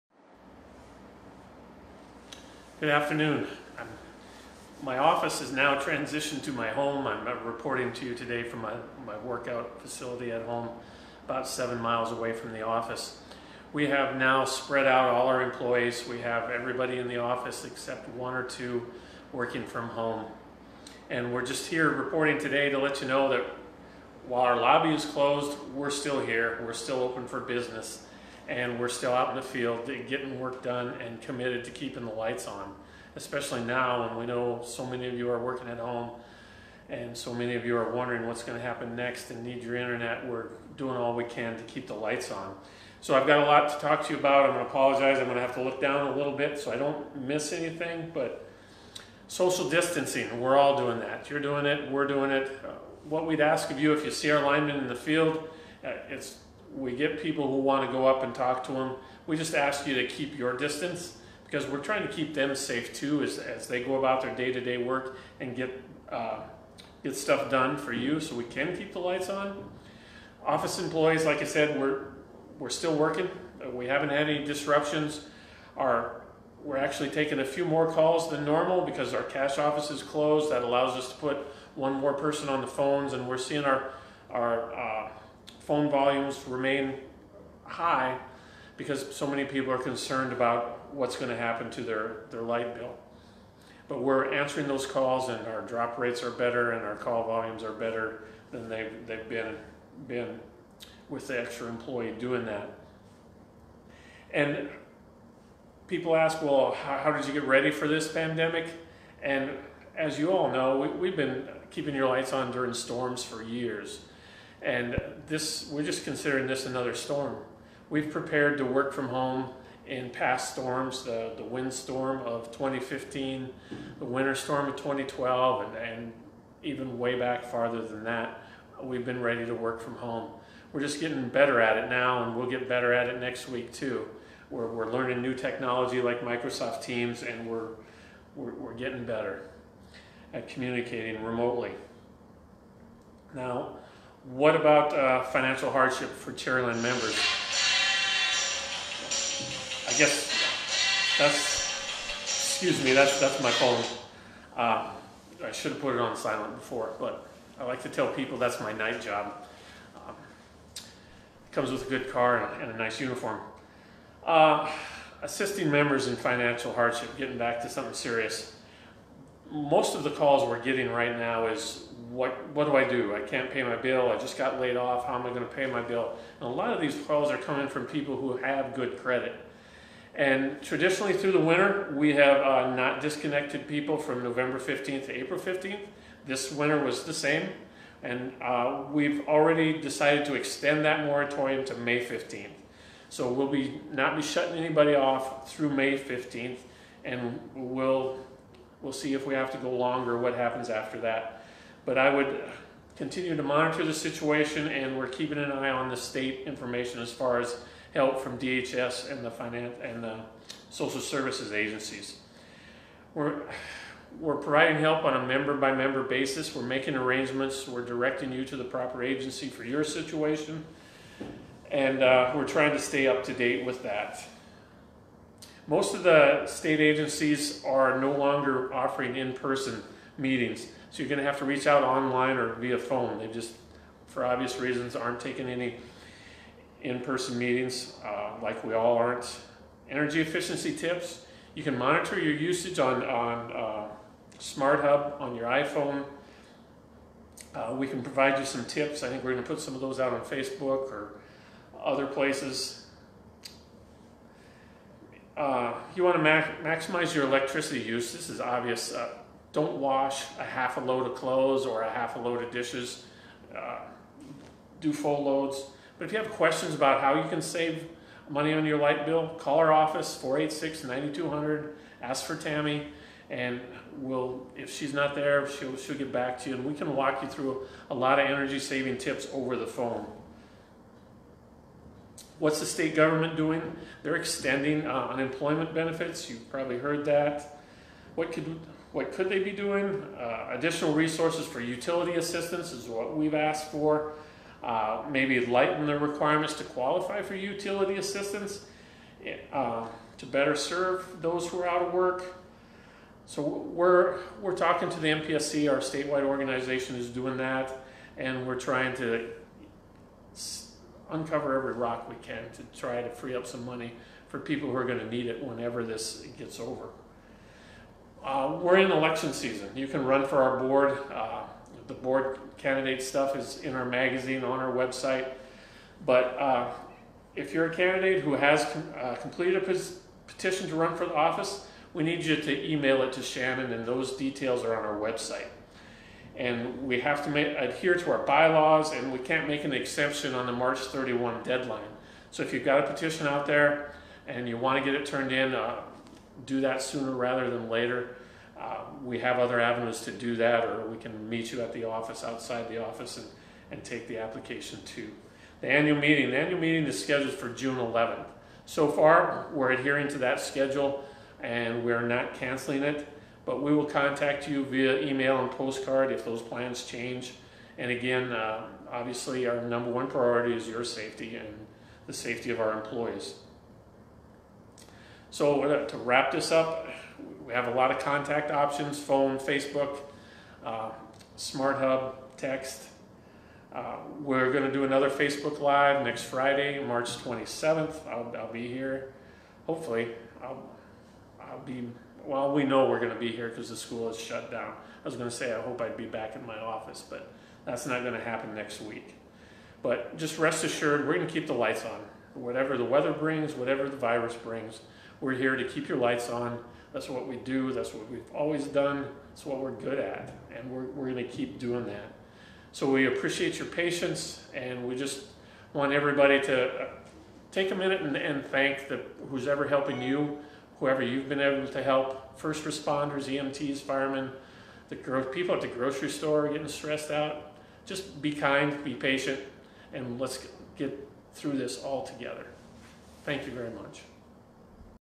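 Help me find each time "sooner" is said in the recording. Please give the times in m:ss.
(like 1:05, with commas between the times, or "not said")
5:46.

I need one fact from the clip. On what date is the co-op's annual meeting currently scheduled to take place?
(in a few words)
June 11th.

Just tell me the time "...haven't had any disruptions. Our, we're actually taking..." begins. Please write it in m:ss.
1:13.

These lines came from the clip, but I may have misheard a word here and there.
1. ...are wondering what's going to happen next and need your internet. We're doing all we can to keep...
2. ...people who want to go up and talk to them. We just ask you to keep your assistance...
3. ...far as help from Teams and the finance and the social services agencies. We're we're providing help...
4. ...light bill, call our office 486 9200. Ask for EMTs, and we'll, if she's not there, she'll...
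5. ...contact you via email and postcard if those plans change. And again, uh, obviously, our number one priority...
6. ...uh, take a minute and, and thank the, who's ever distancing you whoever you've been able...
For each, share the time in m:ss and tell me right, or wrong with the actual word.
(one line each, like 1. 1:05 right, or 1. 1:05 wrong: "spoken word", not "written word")
1. 0:37 right
2. 0:57 wrong: "distance", not "assistance"
3. 3:27 wrong: "DHS", not "Teams"
4. 4:28 wrong: "Tammy", not "EMTs"
5. 6:03 right
6. 6:56 wrong: "helping", not "distancing".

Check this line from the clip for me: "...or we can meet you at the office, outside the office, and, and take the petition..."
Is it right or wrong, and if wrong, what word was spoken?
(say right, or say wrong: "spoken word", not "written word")
wrong: "application", not "petition".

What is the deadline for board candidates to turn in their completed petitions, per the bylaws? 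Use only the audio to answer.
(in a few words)
March 31.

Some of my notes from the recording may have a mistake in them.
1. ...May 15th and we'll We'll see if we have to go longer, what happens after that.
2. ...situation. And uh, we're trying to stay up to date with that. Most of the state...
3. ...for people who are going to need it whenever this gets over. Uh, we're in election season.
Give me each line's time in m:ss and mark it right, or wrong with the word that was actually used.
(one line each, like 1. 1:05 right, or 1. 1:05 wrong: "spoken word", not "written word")
1. 3:15 right
2. 3:39 right
3. 5:14 right.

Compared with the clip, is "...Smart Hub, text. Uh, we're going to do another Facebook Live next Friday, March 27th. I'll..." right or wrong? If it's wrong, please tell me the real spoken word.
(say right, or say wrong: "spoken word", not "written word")
right.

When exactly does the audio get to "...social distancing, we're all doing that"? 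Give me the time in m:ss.
0:49.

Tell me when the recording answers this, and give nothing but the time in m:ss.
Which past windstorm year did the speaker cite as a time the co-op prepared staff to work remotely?
2:02.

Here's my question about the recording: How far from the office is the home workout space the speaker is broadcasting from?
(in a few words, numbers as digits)
7 miles.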